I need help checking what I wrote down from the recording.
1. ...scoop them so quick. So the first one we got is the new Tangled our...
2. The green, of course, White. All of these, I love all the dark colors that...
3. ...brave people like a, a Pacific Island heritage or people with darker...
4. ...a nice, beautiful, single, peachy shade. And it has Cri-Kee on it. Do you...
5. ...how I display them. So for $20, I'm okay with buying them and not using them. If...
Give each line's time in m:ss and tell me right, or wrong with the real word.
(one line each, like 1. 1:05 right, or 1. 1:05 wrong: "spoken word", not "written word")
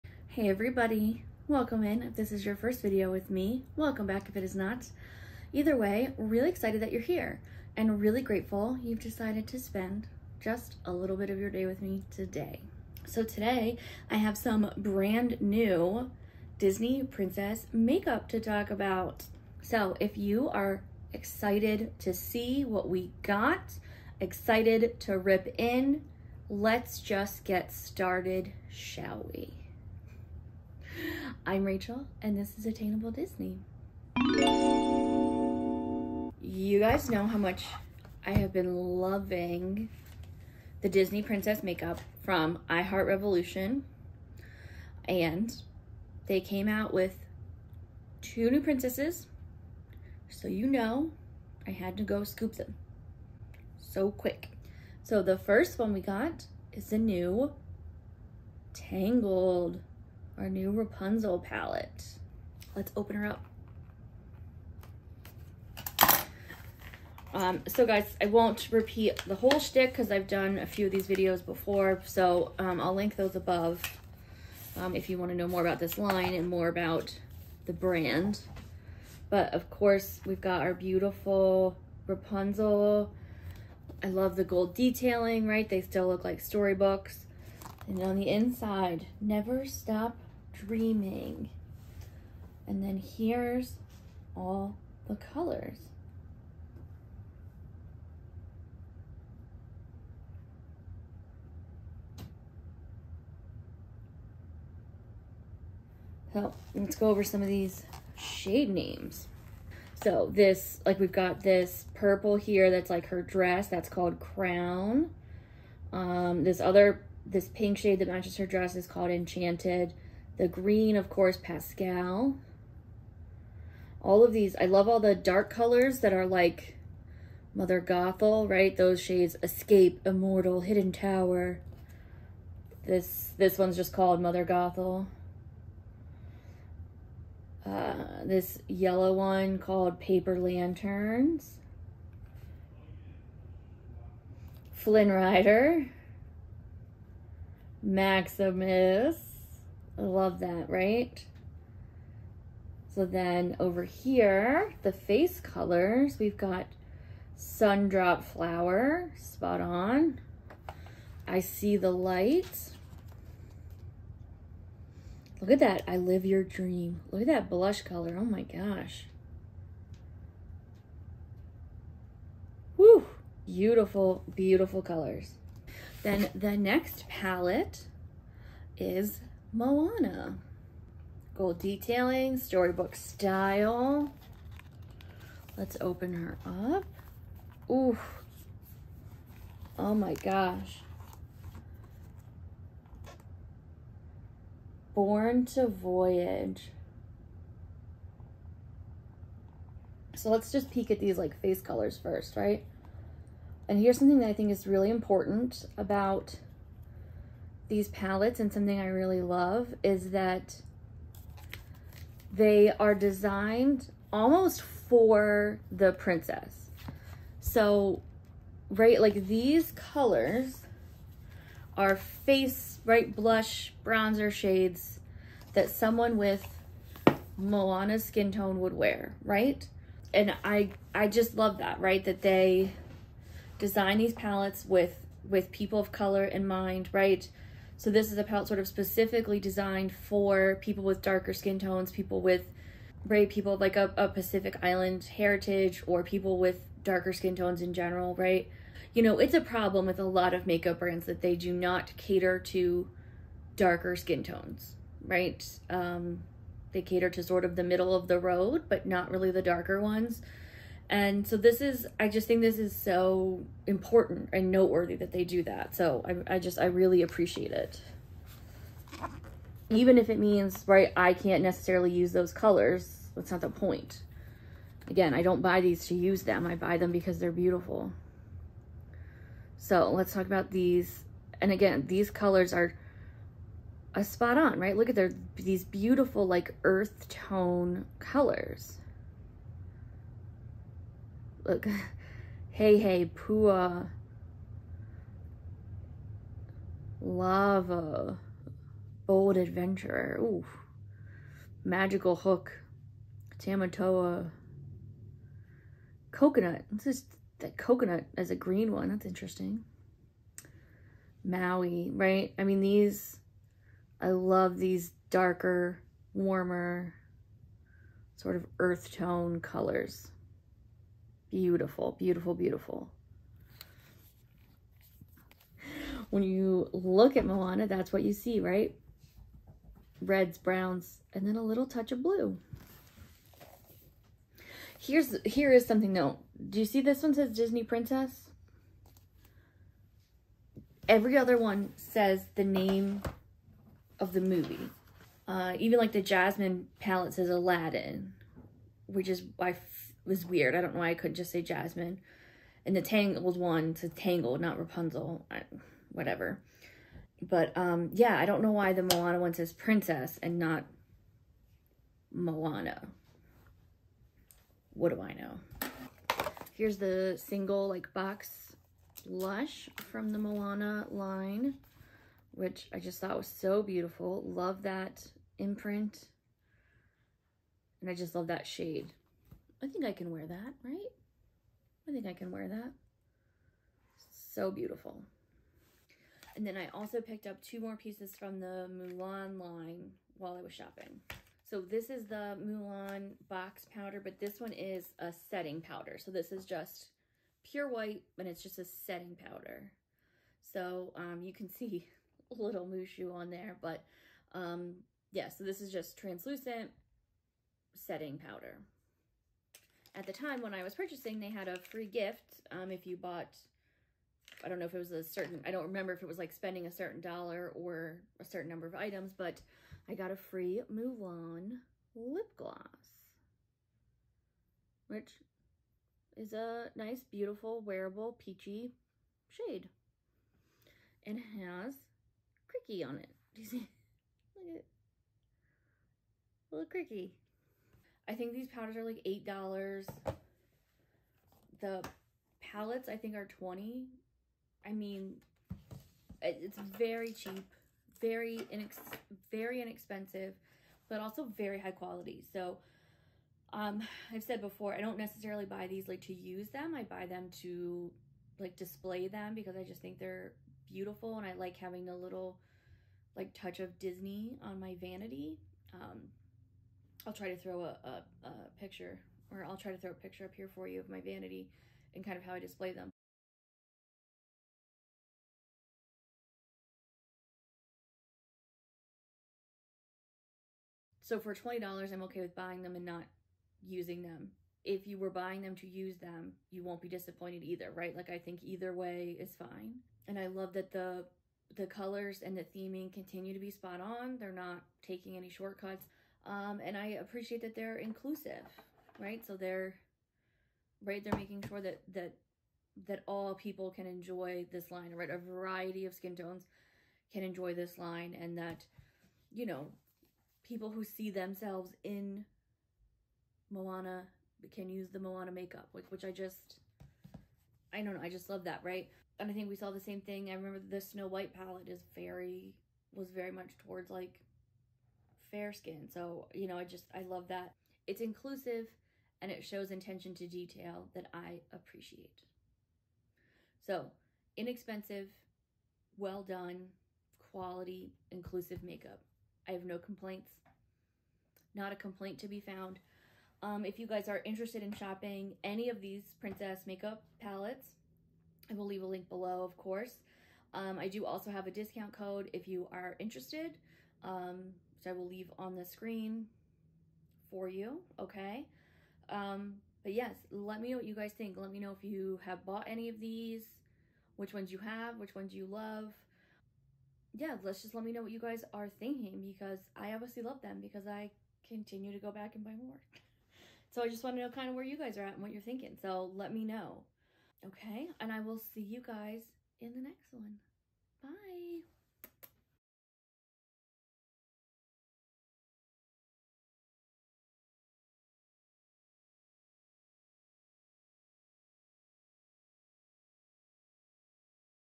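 1. 0:52 right
2. 2:00 wrong: "Pascal", not "White"
3. 4:03 right
4. 7:06 wrong: "wearable", not "single"
5. 7:52 right.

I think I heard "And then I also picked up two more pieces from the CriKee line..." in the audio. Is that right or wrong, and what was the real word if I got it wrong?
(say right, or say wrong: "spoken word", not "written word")
wrong: "Mulan", not "CriKee".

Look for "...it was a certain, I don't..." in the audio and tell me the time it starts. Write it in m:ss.
6:54.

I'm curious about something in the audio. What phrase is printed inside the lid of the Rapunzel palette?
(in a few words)
Never stop dreaming.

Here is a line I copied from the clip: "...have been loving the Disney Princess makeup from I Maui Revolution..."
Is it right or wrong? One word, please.
wrong.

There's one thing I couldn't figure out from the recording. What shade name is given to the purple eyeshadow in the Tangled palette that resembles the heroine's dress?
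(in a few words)
Crown.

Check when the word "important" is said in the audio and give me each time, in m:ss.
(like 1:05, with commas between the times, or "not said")
3:24, 4:23.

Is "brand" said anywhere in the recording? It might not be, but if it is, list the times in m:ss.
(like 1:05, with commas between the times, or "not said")
0:14, 1:17, 4:10.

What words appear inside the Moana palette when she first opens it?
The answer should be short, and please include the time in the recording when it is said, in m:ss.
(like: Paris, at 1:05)
Born to Voyage, at 3:14.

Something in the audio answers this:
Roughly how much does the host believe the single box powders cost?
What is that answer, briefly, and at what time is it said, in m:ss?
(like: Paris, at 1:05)
$8, at 7:19.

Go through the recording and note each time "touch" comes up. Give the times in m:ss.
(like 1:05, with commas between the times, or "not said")
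5:31, 7:43.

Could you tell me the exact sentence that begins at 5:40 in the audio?
Every other one says the name of the movie.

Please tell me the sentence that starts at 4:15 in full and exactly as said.
Um, they cater to sort of the middle of the road, but not really the darker ones.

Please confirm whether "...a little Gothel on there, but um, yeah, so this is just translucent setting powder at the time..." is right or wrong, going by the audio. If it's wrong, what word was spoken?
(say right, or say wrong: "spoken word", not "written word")
wrong: "Mushu", not "Gothel".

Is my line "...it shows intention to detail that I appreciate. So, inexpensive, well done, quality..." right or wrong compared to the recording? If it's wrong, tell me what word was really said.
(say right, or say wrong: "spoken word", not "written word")
right.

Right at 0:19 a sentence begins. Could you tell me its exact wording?
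So if you are excited to see what we got, excited to rip in, let's just get started, shall we?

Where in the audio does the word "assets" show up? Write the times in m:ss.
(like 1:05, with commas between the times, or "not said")
not said.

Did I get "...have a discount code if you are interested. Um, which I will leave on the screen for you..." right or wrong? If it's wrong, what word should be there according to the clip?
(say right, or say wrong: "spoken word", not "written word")
right.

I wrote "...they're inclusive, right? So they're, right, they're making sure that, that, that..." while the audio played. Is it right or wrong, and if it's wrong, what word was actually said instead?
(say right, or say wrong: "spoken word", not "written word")
right.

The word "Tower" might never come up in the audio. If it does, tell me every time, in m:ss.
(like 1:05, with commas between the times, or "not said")
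2:10.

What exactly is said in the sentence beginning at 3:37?
So, right, like these colors are face, right, blush, bronzer shades that someone with Moana's skin tone would wear, right?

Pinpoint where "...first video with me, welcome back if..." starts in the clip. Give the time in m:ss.
0:02.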